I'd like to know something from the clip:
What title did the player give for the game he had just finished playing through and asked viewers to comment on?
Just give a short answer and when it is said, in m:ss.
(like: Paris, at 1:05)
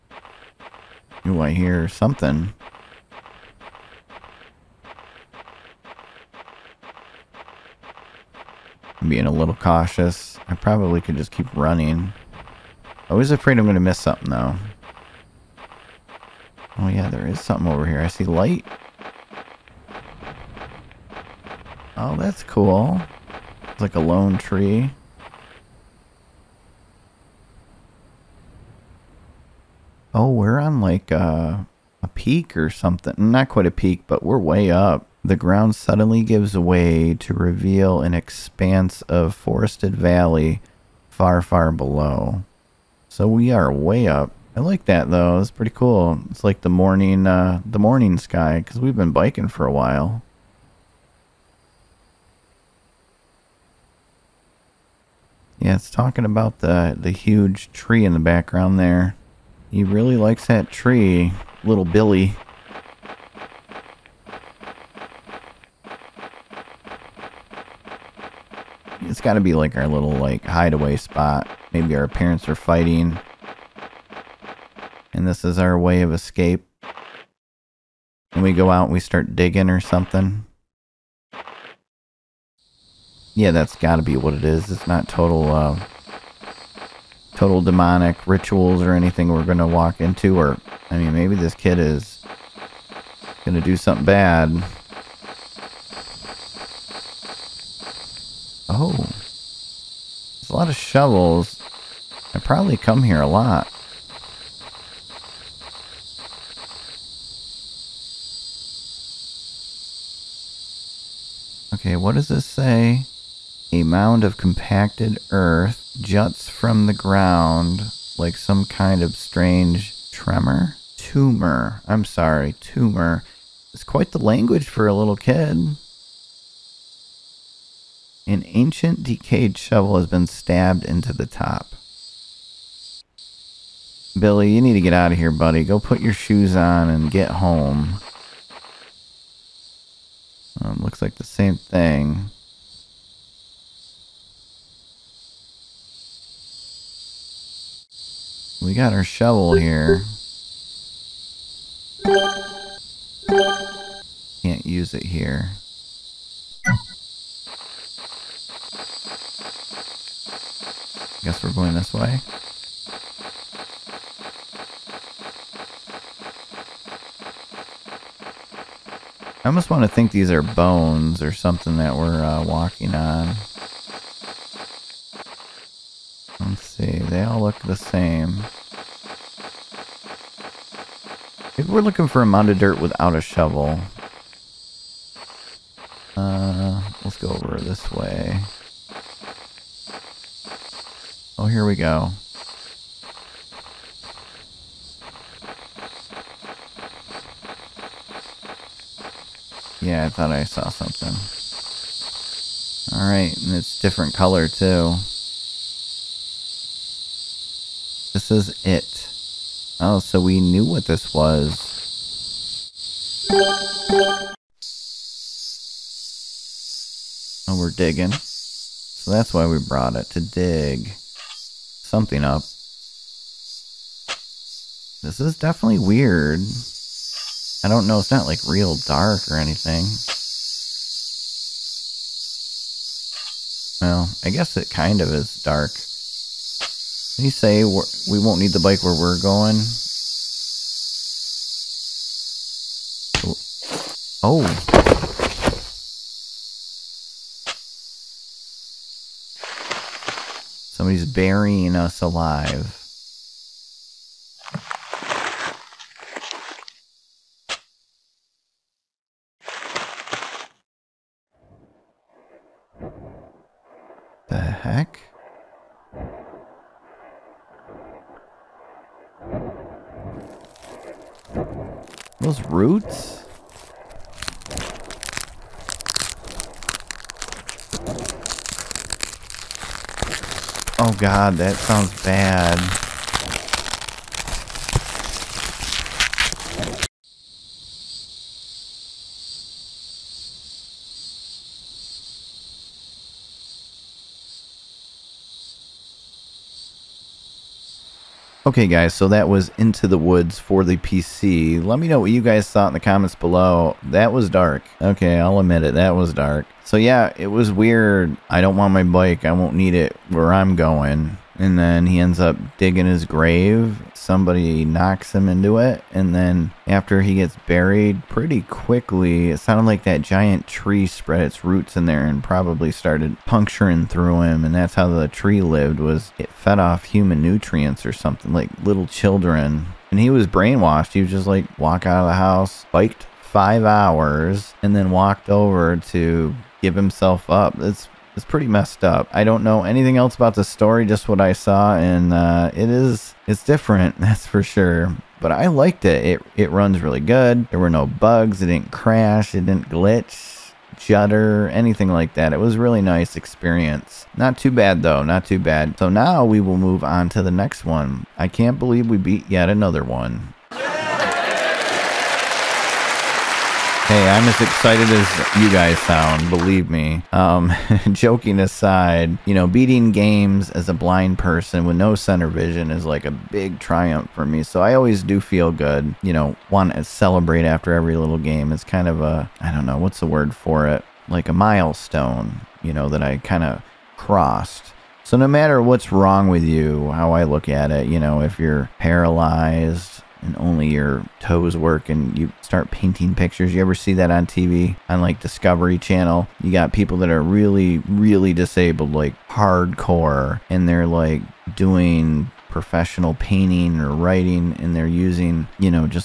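Into the Woods, at 4:59.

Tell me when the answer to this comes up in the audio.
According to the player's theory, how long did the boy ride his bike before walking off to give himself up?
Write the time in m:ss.
5:33.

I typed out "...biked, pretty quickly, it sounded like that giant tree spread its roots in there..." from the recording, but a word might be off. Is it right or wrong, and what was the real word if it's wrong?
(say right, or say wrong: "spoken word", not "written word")
wrong: "buried", not "biked".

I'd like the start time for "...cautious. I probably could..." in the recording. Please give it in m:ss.
0:09.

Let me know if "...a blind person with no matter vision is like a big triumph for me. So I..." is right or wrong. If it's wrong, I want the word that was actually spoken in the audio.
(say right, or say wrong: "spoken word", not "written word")
wrong: "center", not "matter".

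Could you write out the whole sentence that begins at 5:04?
Okay, I'll admit it, that was dark.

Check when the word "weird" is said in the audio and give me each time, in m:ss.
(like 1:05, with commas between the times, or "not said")
3:45, 5:07.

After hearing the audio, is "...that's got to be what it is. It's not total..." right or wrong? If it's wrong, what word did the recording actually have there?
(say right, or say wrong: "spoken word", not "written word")
right.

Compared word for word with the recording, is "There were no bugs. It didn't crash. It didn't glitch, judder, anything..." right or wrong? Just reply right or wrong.
right.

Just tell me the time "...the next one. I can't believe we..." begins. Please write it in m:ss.
5:57.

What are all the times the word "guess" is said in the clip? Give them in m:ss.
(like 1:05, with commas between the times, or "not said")
2:41, 3:54.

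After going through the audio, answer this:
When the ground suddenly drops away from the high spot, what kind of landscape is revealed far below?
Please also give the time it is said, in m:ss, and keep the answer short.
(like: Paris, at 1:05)
forested valley, at 0:39.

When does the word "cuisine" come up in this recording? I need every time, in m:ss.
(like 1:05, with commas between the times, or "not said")
not said.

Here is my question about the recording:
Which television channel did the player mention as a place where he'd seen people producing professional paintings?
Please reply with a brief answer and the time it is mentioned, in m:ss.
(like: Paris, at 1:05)
Discovery Channel, at 6:35.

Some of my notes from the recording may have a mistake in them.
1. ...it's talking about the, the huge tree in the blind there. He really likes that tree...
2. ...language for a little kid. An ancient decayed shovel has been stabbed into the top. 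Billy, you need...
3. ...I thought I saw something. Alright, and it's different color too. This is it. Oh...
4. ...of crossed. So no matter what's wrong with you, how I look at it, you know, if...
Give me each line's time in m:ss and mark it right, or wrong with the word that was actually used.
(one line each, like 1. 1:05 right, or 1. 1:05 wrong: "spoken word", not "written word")
1. 0:55 wrong: "background", not "blind"
2. 2:04 right
3. 3:20 right
4. 6:23 right.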